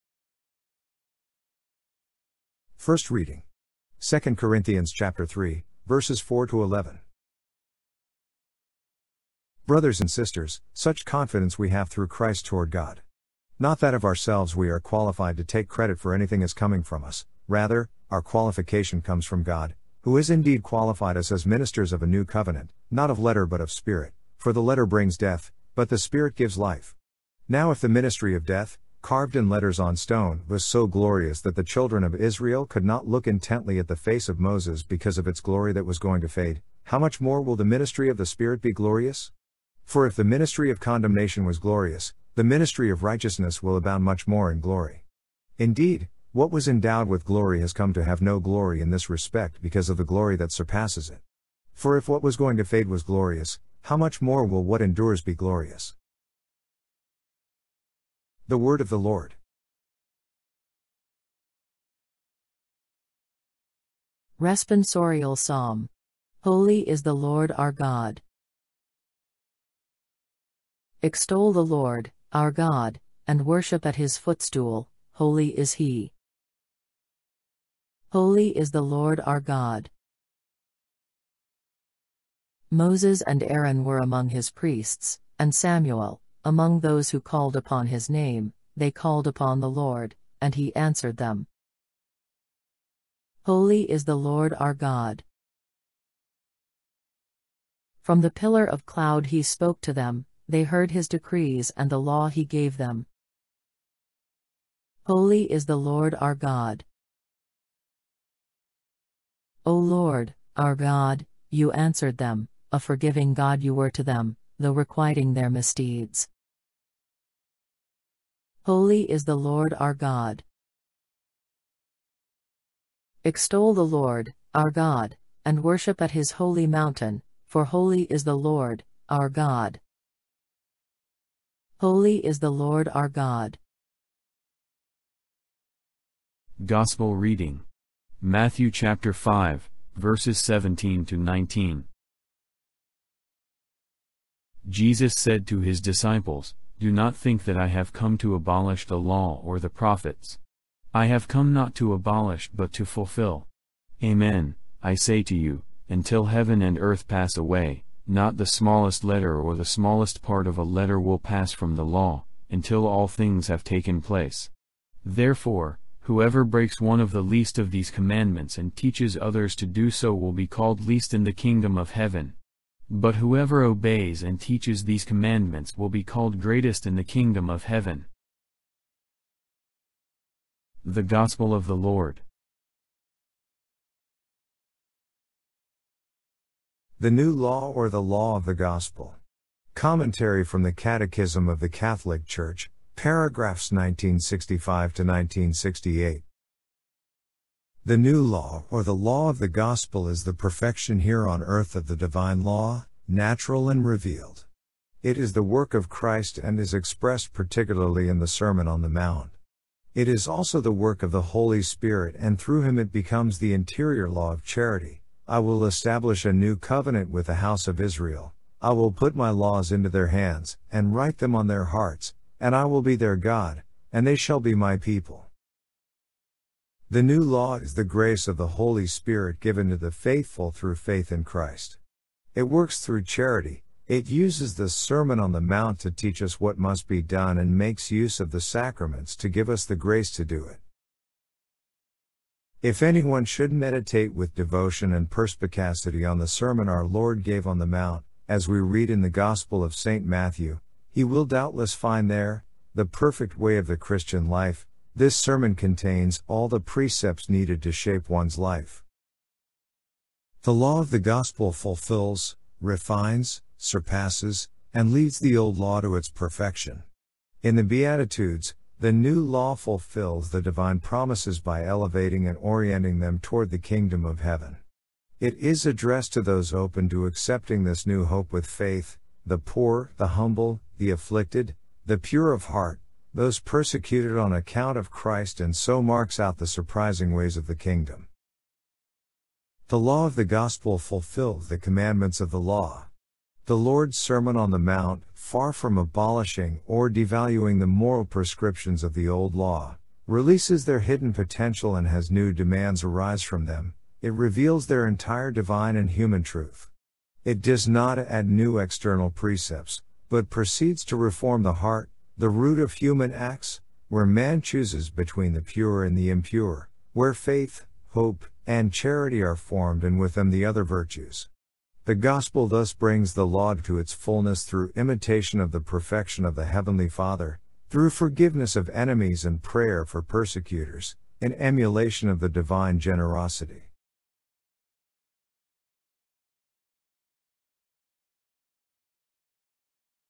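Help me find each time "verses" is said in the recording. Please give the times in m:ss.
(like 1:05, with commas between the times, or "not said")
0:05, 2:19.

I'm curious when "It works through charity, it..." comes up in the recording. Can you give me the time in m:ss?
3:52.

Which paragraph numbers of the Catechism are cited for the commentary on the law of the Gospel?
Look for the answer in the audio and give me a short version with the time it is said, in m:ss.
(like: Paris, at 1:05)
1965 to 1968, at 3:13.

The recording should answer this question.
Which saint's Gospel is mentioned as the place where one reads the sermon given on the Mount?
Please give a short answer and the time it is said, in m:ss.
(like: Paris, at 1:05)
St. Matthew, at 4:09.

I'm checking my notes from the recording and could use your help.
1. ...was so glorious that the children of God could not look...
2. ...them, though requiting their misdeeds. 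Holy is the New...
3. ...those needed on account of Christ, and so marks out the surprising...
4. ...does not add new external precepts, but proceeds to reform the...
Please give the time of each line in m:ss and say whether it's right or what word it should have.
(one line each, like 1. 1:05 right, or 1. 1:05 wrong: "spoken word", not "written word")
1. 0:30 wrong: "Israel", not "God"
2. 1:54 wrong: "Lord", not "New"
3. 4:43 wrong: "persecuted", not "needed"
4. 5:07 right.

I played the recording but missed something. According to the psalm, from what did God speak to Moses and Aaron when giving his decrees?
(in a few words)
The pillar of cloud.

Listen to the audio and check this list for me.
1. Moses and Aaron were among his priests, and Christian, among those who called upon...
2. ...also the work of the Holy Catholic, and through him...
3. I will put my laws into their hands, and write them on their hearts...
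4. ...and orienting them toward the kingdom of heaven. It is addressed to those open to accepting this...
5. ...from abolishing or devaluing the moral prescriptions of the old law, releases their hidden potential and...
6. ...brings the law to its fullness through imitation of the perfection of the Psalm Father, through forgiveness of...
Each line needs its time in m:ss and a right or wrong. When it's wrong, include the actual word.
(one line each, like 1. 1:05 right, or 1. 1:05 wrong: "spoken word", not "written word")
1. 1:22 wrong: "Samuel", not "Christian"
2. 3:30 wrong: "Spirit", not "Catholic"
3. 3:38 right
4. 4:32 right
5. 4:55 right
6. 5:22 wrong: "Heavenly", not "Psalm".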